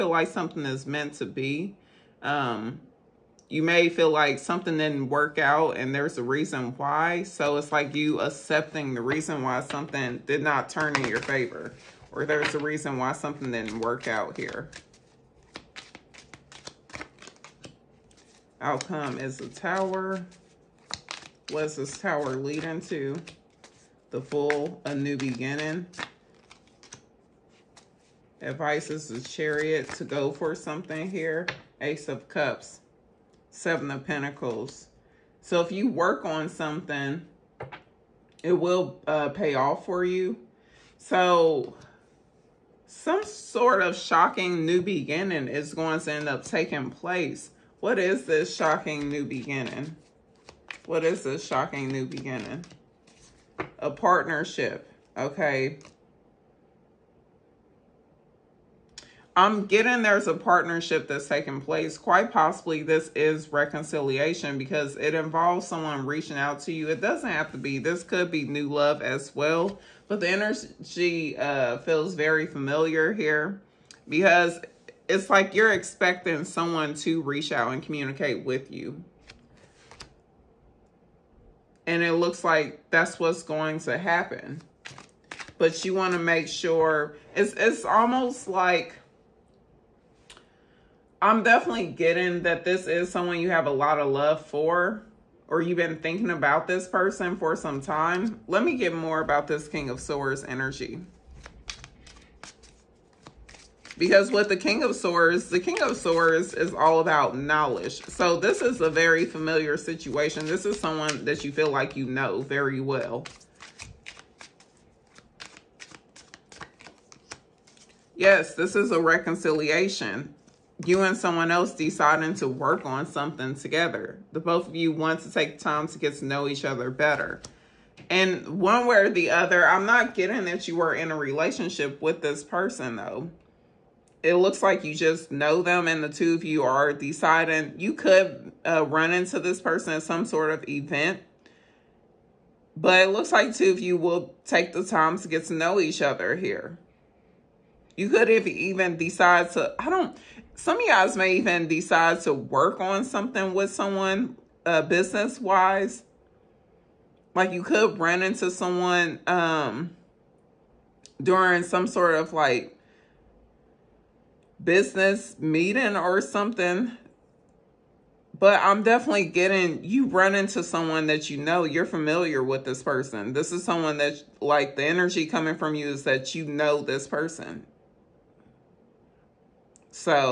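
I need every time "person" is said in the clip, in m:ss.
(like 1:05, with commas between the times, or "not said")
1:36, 2:12, 2:19, 2:52, 2:57.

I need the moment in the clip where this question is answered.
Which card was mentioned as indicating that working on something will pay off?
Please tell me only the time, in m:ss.
0:33.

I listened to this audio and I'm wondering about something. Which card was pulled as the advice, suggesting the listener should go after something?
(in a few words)
The Chariot.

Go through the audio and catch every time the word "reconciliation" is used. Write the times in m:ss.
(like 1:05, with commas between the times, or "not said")
1:03, 1:58.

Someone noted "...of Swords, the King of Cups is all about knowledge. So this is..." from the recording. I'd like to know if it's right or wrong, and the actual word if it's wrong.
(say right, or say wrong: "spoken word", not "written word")
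wrong: "Swords", not "Cups".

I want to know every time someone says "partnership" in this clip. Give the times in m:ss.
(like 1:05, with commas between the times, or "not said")
0:53, 1:00.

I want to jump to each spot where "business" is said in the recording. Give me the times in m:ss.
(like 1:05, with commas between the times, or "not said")
2:34, 2:44.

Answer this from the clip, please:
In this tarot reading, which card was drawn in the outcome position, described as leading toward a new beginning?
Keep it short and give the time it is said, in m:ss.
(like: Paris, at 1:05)
The Tower, at 0:18.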